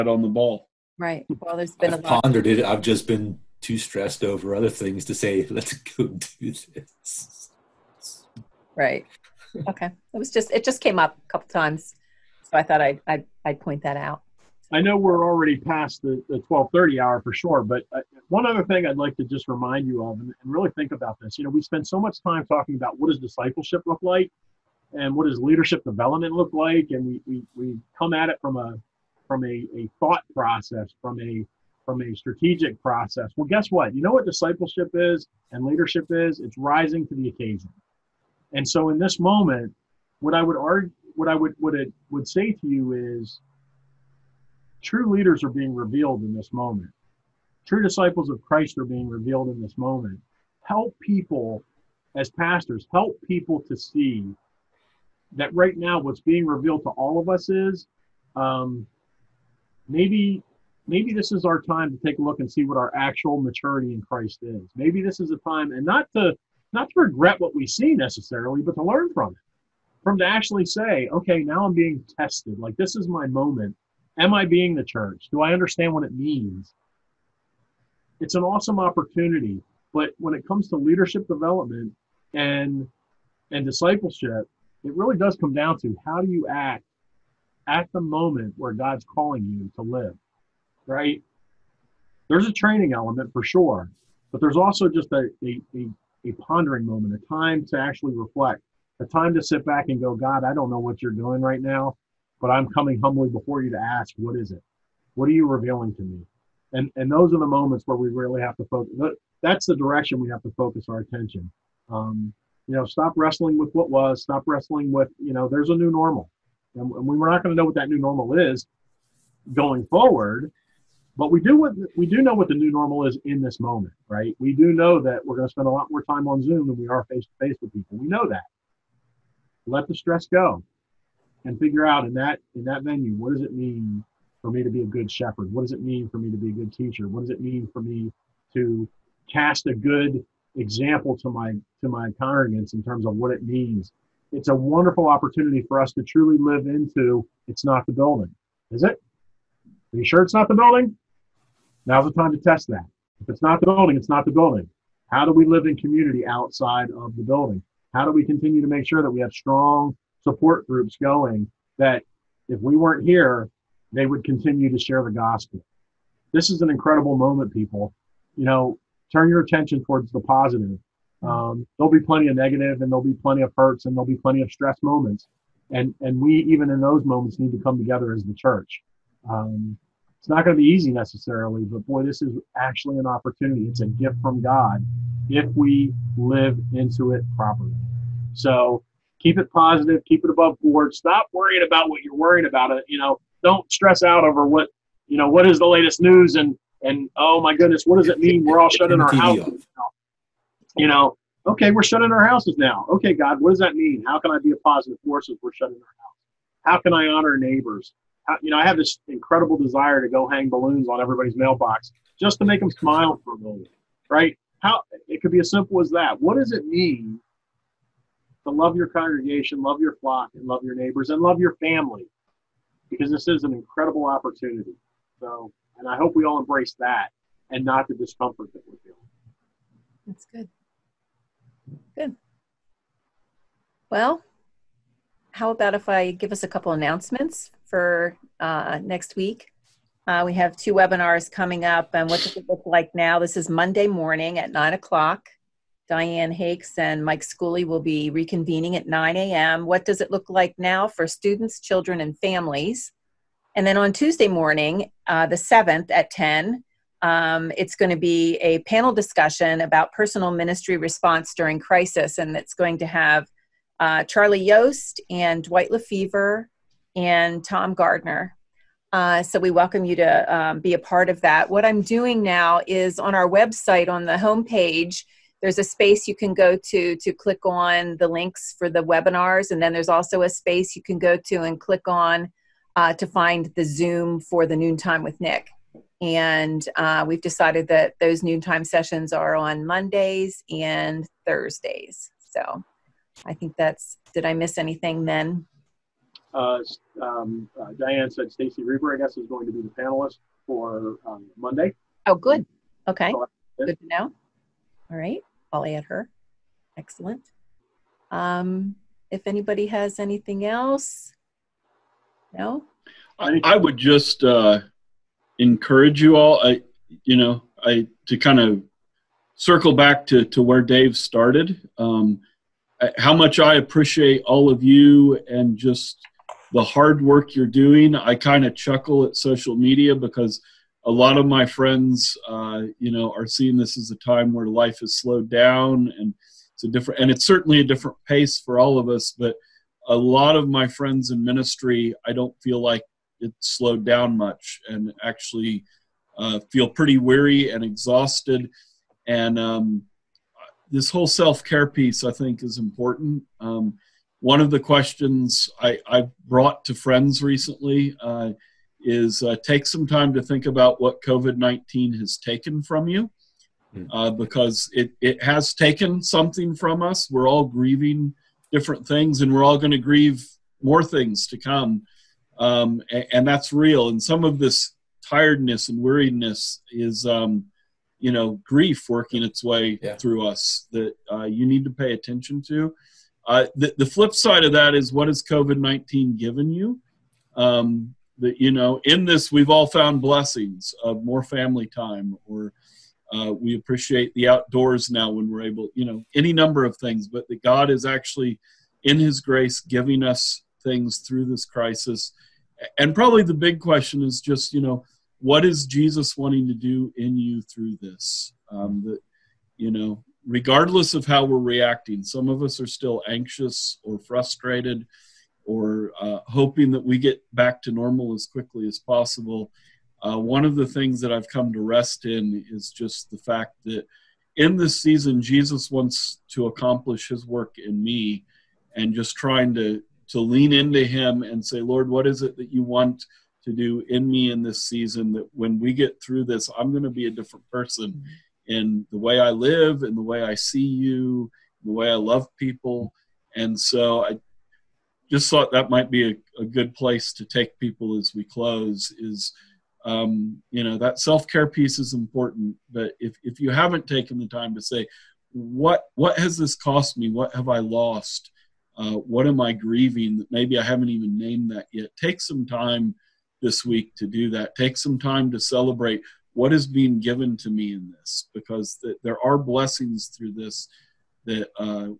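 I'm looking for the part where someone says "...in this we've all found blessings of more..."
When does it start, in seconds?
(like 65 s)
388 s.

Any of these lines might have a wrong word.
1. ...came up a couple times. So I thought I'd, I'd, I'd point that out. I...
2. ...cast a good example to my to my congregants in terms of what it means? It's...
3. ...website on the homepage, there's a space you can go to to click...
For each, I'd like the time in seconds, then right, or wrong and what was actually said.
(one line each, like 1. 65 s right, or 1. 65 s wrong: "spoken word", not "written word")
1. 10 s right
2. 139 s right
3. 273 s right.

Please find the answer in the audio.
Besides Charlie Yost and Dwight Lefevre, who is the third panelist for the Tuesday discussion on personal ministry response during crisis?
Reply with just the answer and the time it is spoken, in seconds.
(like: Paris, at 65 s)
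Tom Gardner, at 267 s.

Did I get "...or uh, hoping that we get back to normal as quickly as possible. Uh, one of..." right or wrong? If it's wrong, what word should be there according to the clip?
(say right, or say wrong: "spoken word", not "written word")
right.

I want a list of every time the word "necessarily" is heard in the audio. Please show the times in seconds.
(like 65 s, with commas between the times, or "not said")
67 s, 180 s.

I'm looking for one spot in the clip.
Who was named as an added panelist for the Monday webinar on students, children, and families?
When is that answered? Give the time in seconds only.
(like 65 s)
298 s.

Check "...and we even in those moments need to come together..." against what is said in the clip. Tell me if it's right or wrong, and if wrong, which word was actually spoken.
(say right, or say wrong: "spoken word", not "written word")
right.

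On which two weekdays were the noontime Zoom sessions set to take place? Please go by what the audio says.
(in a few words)
Mondays and Thursdays.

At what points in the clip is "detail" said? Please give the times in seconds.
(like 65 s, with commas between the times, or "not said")
not said.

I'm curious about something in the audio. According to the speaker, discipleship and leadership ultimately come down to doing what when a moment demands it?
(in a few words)
Rising to the occasion.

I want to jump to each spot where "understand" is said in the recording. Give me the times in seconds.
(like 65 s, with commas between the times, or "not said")
75 s.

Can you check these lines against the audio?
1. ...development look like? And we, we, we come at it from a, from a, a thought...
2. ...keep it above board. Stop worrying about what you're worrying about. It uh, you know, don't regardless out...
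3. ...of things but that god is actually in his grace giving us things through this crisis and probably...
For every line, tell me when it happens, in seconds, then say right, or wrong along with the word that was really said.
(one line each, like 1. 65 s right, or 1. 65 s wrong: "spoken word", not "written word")
1. 25 s right
2. 190 s wrong: "stress", not "regardless"
3. 396 s right.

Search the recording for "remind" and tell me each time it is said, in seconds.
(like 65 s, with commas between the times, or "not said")
19 s.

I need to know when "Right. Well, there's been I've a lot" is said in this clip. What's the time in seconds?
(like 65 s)
0 s.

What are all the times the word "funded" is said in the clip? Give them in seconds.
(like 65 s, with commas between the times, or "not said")
not said.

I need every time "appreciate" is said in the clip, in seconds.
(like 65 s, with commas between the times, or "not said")
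323 s, 393 s.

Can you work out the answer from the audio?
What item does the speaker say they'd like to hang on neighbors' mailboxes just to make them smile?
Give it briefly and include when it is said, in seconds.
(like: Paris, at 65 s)
Balloons, at 210 s.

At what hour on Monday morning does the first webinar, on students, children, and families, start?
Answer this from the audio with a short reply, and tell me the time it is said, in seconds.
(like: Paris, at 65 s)
9, at 244 s.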